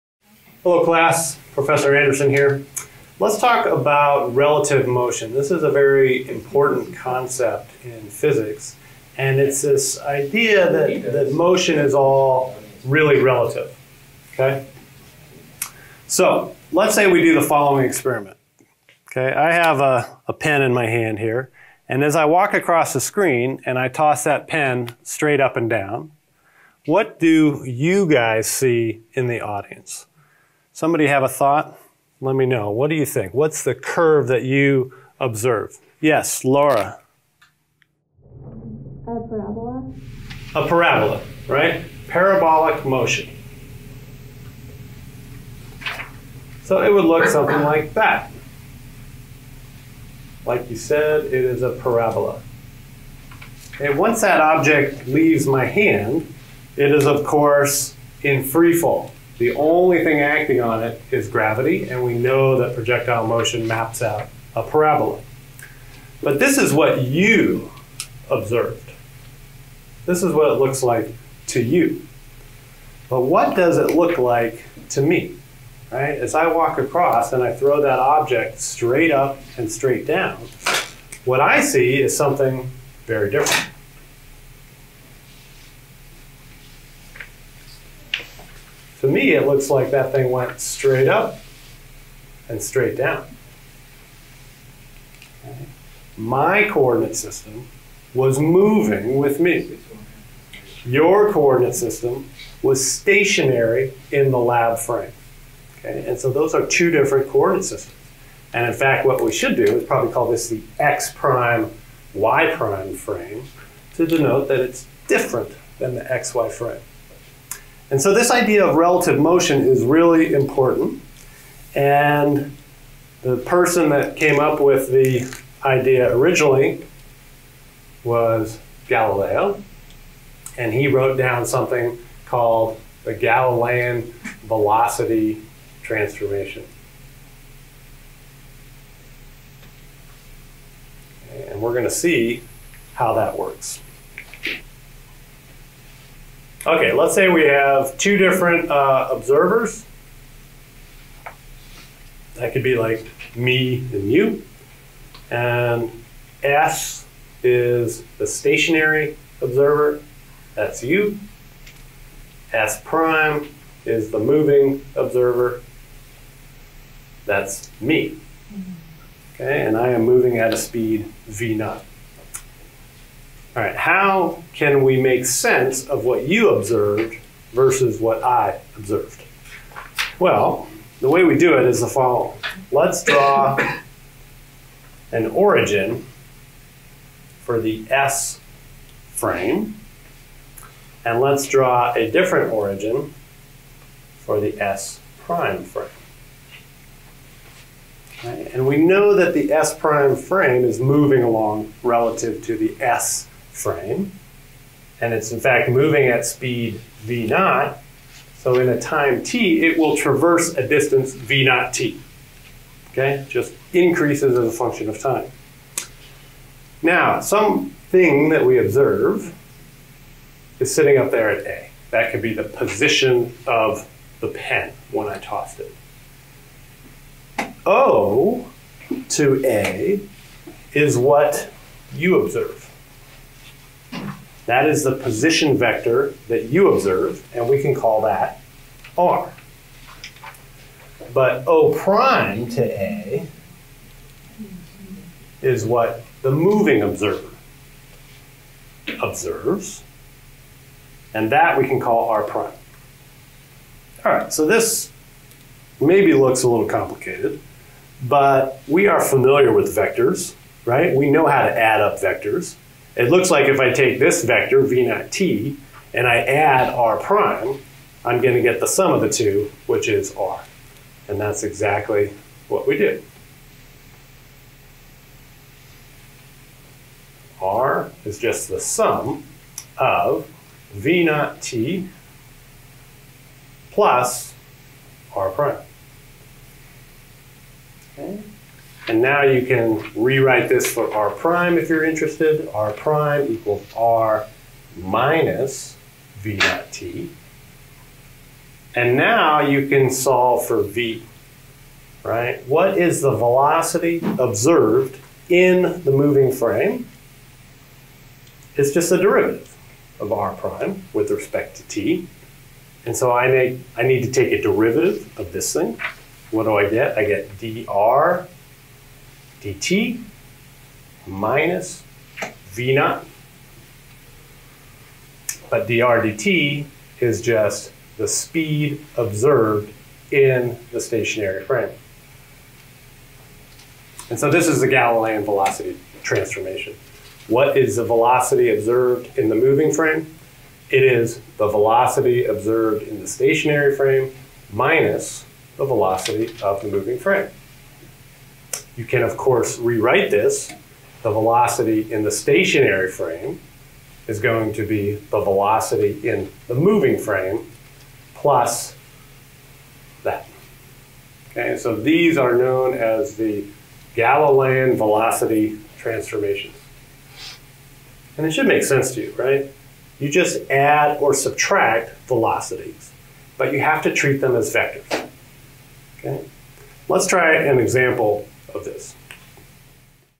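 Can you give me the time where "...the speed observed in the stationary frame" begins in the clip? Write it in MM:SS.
05:27.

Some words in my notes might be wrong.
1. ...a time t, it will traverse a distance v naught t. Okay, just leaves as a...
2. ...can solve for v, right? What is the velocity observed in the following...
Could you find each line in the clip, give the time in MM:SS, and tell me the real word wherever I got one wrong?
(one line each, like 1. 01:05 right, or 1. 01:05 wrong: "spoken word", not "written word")
1. 03:28 wrong: "increases", not "leaves"
2. 04:59 wrong: "moving", not "following".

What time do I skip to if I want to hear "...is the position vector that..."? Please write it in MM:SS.
03:54.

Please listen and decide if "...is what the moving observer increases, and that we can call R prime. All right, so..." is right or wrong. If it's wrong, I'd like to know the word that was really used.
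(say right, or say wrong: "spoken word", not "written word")
wrong: "observes", not "increases".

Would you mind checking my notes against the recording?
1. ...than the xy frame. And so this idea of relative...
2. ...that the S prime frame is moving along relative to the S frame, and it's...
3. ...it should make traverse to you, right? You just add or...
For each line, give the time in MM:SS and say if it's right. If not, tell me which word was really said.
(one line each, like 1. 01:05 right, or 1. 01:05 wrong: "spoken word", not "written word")
1. 01:55 right
2. 03:19 right
3. 06:08 wrong: "sense", not "traverse".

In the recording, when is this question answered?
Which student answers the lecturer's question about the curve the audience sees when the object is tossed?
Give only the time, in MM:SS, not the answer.
00:36.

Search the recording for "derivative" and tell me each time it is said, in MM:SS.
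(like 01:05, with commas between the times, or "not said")
05:08, 05:14.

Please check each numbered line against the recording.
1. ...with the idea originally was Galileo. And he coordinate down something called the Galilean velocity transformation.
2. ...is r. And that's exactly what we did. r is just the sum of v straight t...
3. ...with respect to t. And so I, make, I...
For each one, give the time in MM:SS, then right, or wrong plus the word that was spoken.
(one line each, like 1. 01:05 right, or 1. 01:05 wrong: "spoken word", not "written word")
1. 02:04 wrong: "wrote", not "coordinate"
2. 04:29 wrong: "naught", not "straight"
3. 05:10 right.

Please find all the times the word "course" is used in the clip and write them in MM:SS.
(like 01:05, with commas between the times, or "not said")
00:57, 05:49.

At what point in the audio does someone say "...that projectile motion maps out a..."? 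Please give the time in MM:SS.
01:02.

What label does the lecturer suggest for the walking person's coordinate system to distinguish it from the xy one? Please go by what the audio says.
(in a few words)
x prime, y prime.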